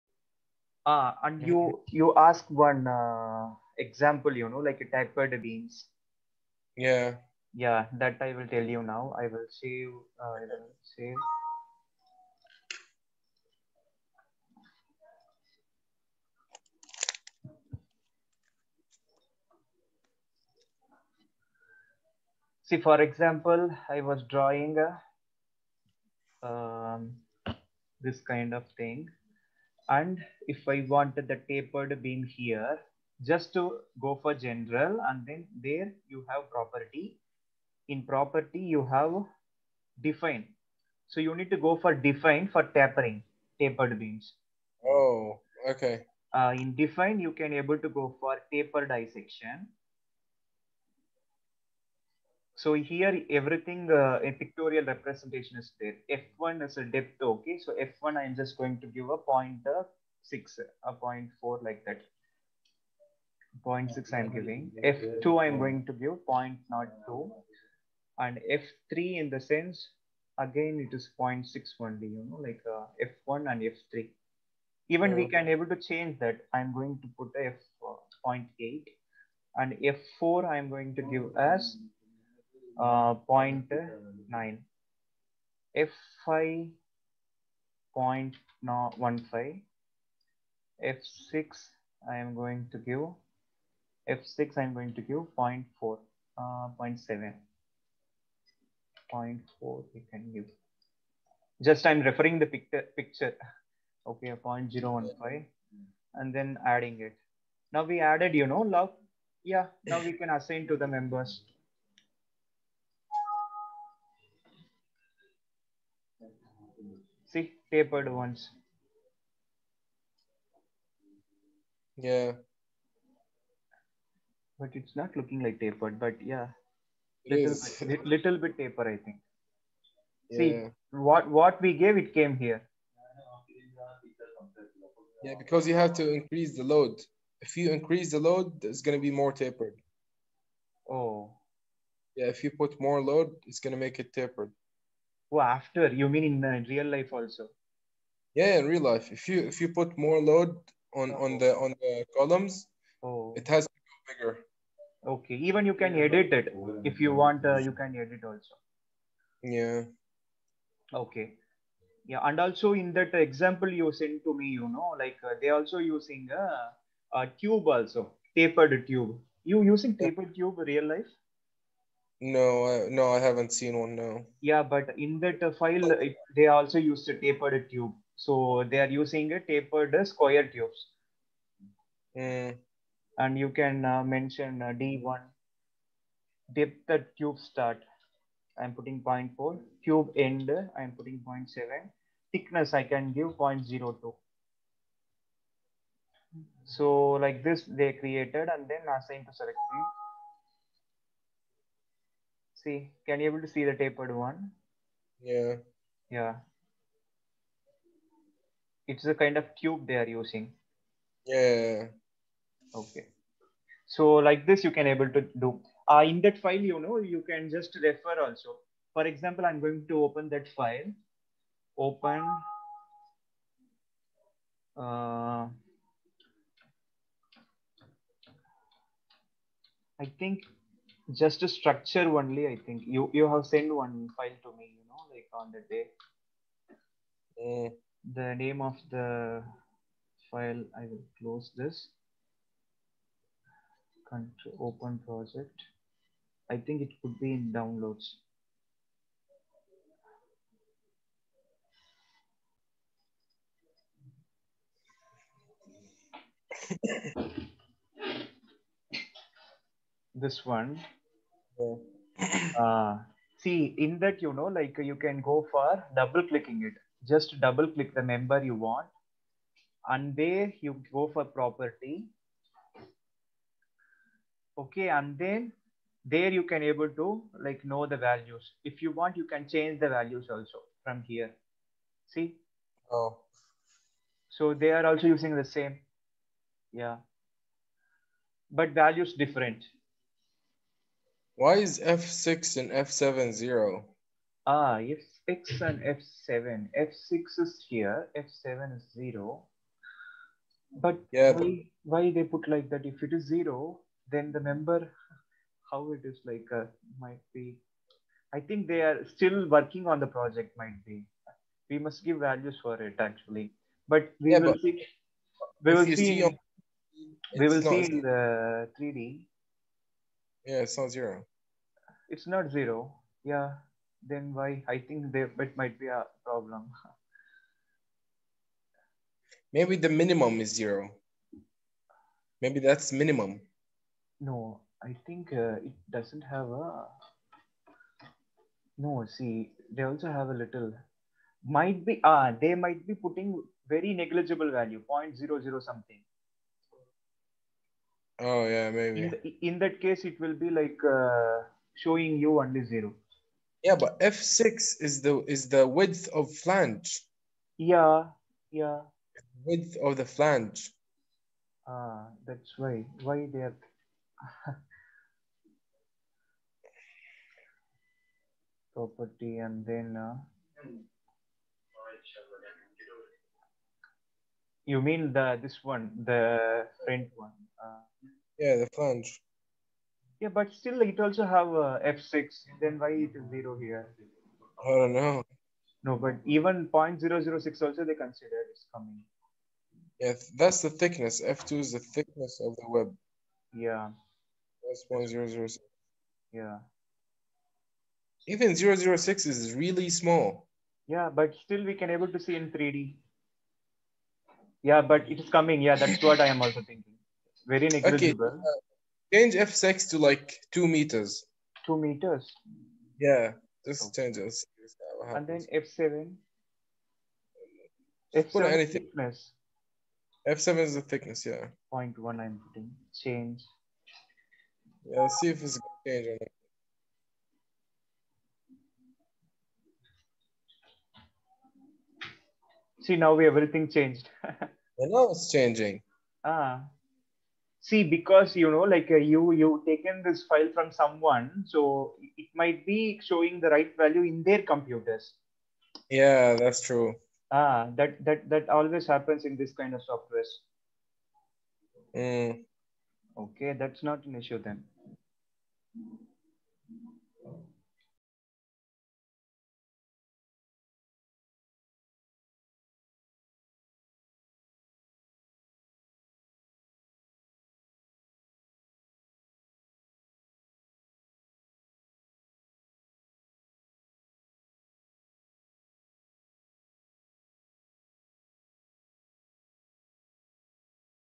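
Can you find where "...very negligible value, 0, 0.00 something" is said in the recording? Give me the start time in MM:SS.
05:43.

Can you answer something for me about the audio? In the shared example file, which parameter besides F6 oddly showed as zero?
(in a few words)
F7.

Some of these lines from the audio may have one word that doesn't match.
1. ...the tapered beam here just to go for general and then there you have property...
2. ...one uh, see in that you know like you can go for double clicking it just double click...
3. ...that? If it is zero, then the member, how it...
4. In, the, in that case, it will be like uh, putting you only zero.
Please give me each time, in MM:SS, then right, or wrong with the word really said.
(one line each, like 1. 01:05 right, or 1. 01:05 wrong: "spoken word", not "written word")
1. 00:31 right
2. 04:20 right
3. 05:02 right
4. 05:49 wrong: "showing", not "putting".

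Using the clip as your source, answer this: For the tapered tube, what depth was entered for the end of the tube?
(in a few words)
0.7.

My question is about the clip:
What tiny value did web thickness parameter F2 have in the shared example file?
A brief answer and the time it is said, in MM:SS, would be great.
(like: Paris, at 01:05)
0.006, at 06:34.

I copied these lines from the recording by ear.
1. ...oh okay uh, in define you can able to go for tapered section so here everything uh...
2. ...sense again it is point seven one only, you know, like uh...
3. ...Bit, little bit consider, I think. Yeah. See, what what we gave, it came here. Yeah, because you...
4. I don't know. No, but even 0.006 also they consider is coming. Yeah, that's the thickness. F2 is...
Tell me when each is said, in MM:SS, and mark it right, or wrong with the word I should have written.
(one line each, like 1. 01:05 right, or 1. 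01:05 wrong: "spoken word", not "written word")
1. 00:44 right
2. 01:09 wrong: "six", not "seven"
3. 02:07 wrong: "taper", not "consider"
4. 06:24 right.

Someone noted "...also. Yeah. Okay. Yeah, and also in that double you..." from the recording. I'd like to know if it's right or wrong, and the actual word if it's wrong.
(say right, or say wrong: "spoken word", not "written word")
wrong: "example", not "double".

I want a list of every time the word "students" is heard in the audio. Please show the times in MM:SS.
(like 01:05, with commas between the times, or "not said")
not said.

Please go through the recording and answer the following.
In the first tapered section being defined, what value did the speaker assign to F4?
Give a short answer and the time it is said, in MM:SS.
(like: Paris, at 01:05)
0.9, at 01:19.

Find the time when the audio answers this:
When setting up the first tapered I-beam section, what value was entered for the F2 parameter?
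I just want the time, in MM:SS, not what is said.
01:04.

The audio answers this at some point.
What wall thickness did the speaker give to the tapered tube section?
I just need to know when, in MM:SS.
03:12.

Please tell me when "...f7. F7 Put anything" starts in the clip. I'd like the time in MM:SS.
06:55.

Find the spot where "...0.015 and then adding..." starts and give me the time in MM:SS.
01:44.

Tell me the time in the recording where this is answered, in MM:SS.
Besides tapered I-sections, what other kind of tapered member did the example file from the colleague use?
02:59.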